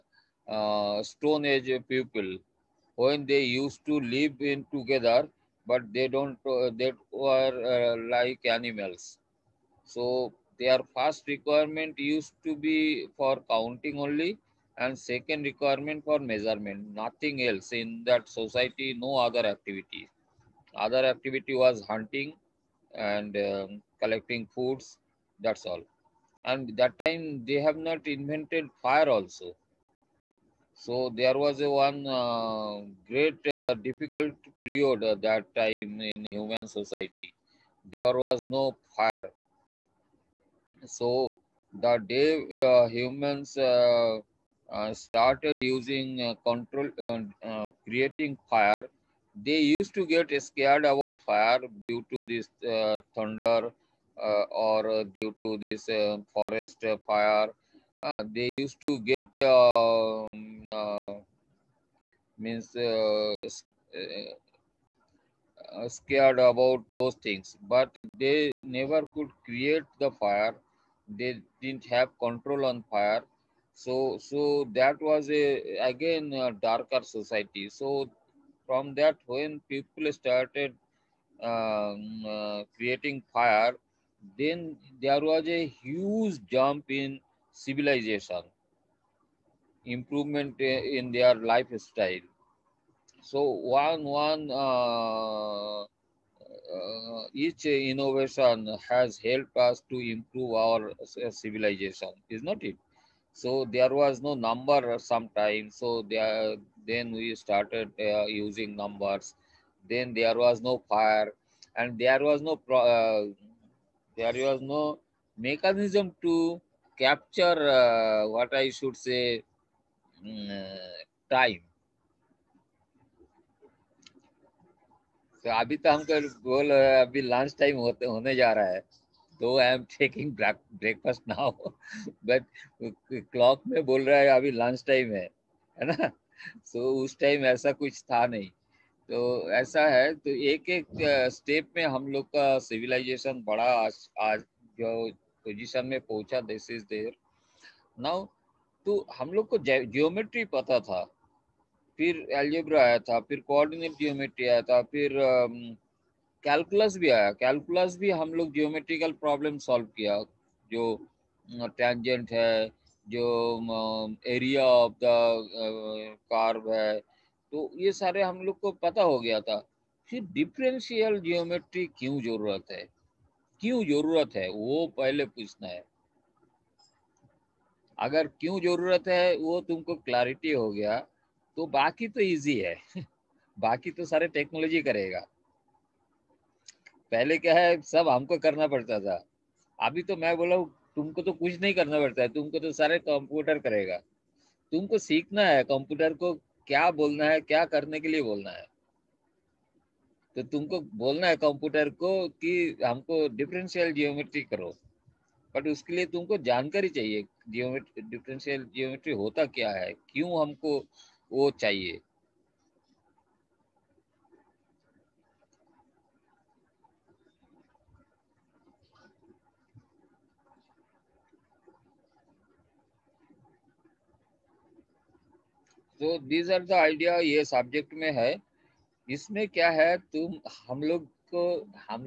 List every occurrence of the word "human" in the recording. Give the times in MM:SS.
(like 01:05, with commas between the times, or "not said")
00:36, 00:42.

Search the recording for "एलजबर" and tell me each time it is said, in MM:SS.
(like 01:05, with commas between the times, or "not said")
02:32.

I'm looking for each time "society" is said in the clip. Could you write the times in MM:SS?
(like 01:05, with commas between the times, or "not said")
00:18, 00:36, 01:17.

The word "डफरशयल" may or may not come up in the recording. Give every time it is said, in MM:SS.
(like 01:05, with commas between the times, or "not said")
02:50, 03:23, 03:28.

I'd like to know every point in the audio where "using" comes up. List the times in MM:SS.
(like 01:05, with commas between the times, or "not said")
00:45, 01:48.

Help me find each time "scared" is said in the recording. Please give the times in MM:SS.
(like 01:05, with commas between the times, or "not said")
00:50, 01:05.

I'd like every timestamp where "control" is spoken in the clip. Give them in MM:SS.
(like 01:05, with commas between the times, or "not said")
00:46, 01:12.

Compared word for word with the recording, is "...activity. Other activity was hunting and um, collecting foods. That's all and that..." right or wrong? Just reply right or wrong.
right.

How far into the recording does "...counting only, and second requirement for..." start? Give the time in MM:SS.
00:13.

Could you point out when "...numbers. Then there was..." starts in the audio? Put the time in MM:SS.
01:48.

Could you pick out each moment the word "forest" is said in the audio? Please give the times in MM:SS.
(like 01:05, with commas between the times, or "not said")
00:56.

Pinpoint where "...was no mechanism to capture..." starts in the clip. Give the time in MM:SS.
01:54.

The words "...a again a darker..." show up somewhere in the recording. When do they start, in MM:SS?
01:15.